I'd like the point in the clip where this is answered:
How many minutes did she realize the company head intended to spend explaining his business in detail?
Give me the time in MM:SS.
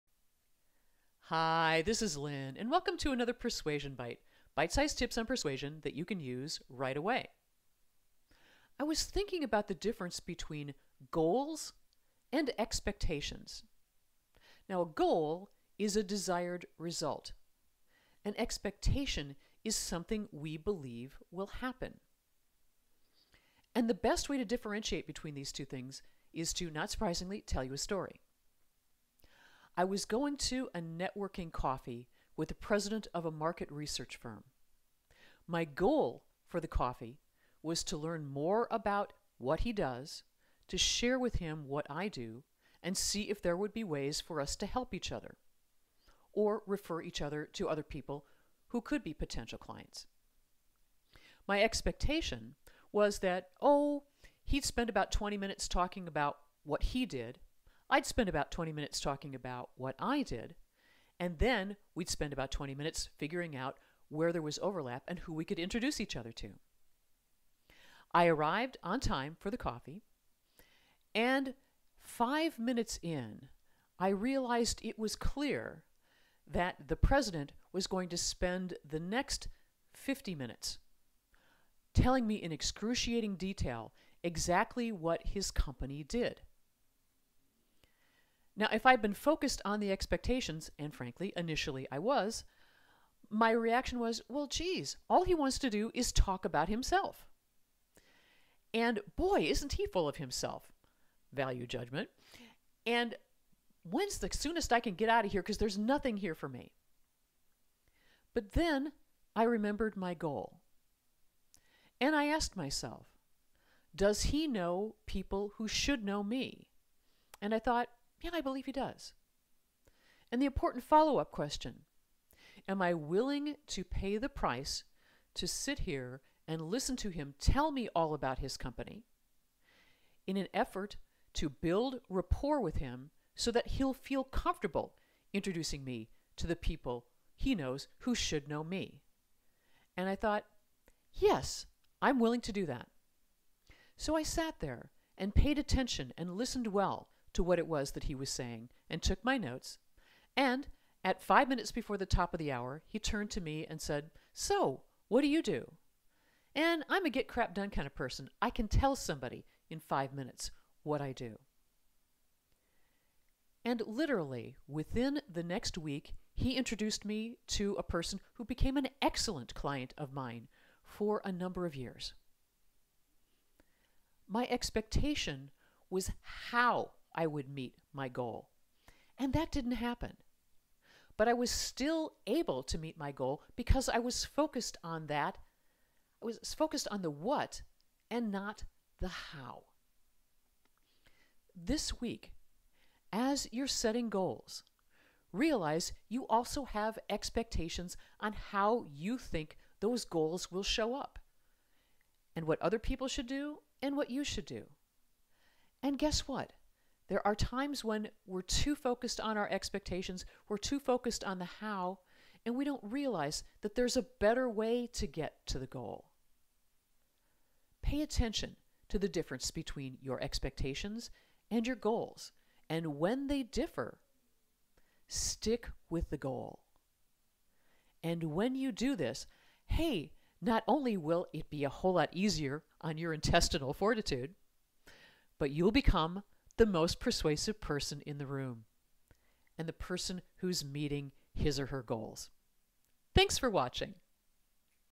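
01:19.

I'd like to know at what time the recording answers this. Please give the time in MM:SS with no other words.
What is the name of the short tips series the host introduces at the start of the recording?
00:03.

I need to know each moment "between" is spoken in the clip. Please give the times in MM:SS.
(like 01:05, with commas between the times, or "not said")
00:10, 00:25, 03:39.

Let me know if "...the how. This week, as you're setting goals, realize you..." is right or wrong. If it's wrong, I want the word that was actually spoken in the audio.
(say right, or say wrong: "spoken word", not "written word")
right.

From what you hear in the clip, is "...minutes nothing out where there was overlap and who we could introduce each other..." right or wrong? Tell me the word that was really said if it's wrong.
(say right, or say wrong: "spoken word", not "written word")
wrong: "figuring", not "nothing".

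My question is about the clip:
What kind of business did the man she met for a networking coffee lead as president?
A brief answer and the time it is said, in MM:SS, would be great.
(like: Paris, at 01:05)
market research firm, at 00:33.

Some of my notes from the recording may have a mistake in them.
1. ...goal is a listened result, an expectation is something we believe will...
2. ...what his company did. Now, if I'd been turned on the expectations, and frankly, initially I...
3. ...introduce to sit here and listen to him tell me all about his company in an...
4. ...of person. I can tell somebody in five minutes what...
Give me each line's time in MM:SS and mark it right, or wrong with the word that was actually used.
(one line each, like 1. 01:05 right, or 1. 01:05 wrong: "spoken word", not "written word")
1. 00:14 wrong: "desired", not "listened"
2. 01:24 wrong: "focused", not "turned"
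3. 02:04 wrong: "price", not "introduce"
4. 02:37 right.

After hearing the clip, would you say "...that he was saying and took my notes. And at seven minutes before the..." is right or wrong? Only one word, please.
wrong.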